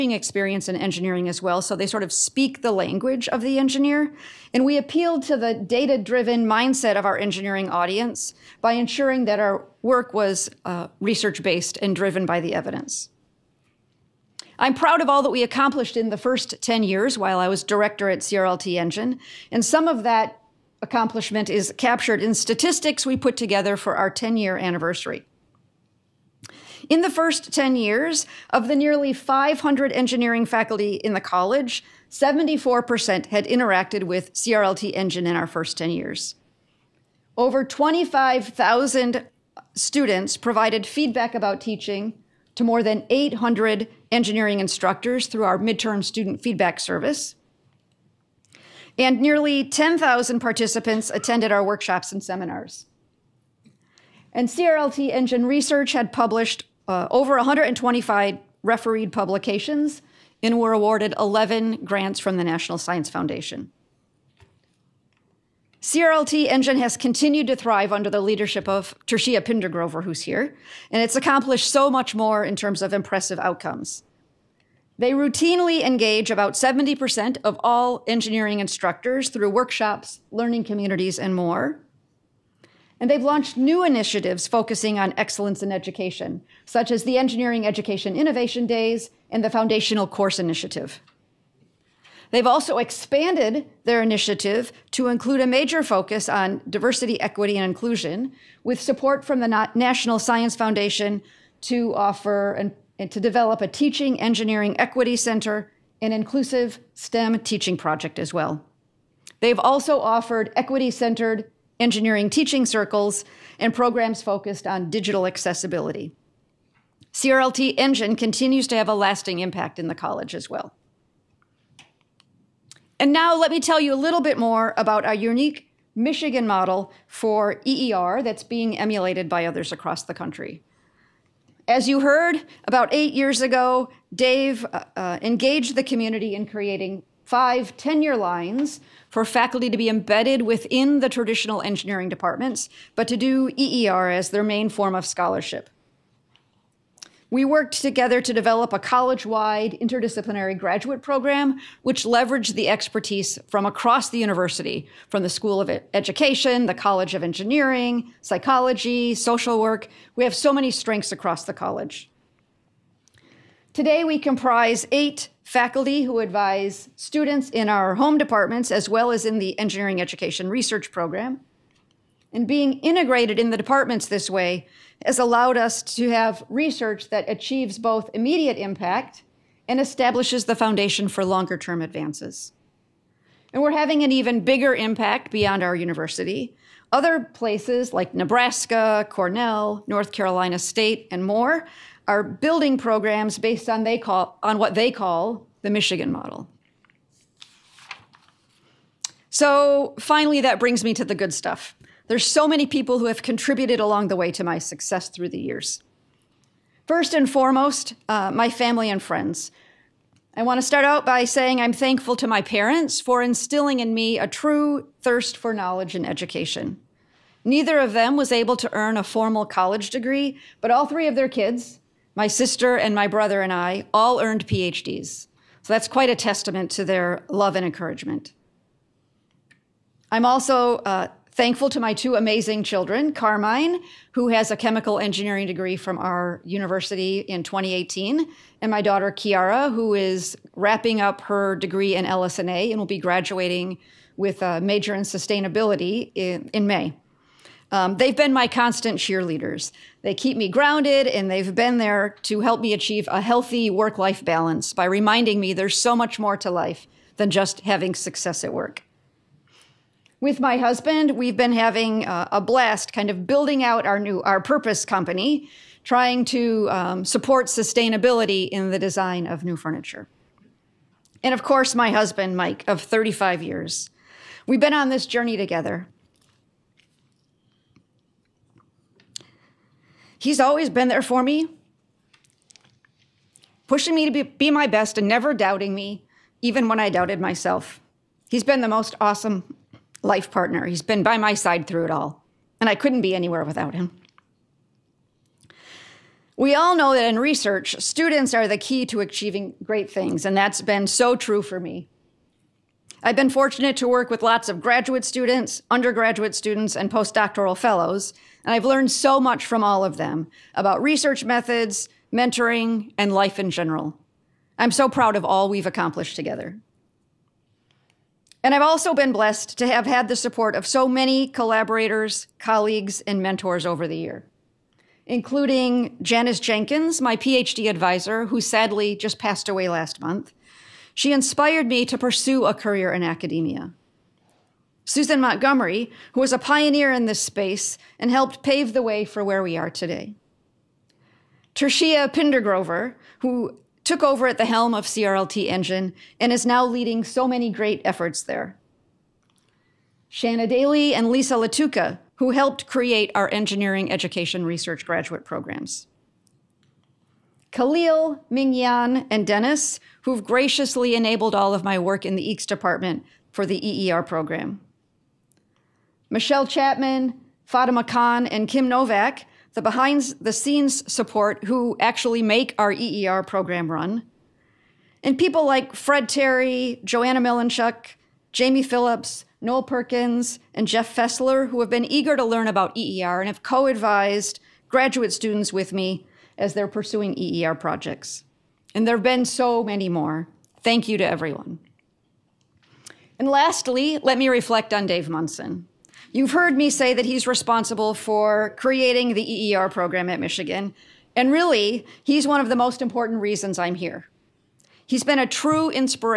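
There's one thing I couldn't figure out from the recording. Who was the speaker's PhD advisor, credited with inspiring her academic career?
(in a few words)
Janice Jenkins.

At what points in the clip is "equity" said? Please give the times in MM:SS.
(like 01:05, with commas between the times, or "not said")
01:37, 01:44, 01:50.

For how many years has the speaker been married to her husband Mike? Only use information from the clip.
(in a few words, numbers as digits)
35.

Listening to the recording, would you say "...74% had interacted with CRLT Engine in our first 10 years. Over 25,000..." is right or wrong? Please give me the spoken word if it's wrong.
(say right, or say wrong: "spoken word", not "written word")
right.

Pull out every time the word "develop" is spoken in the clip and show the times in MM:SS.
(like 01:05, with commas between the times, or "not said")
01:43, 02:28.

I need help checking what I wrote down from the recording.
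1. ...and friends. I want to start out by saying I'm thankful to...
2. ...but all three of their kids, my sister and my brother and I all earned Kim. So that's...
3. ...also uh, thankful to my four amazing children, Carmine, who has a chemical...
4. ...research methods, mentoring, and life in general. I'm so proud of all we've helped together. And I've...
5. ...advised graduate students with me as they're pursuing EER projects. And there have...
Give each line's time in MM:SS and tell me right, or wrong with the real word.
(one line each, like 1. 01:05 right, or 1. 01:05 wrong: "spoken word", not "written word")
1. 03:28 right
2. 03:40 wrong: "PhDs", not "Kim"
3. 03:50 wrong: "two", not "four"
4. 05:10 wrong: "accomplished", not "helped"
5. 06:23 right.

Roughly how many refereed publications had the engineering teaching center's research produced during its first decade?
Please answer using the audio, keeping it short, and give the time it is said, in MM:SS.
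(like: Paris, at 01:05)
over 125, at 00:57.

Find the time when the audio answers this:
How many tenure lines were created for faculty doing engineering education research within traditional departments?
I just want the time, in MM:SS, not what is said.
02:17.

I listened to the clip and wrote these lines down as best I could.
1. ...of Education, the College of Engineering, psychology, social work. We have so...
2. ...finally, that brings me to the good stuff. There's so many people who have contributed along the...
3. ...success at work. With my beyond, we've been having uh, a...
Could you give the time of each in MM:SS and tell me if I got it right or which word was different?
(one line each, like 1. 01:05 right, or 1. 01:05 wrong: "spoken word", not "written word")
1. 02:35 right
2. 03:19 right
3. 04:17 wrong: "husband", not "beyond".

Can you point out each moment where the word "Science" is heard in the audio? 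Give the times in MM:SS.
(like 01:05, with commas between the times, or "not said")
01:02, 01:40.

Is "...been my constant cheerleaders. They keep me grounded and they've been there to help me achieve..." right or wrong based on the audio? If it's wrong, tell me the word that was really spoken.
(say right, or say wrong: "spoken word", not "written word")
right.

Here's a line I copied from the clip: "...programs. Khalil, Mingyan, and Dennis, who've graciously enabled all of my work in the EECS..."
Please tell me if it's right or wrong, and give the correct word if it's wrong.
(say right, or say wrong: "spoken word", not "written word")
right.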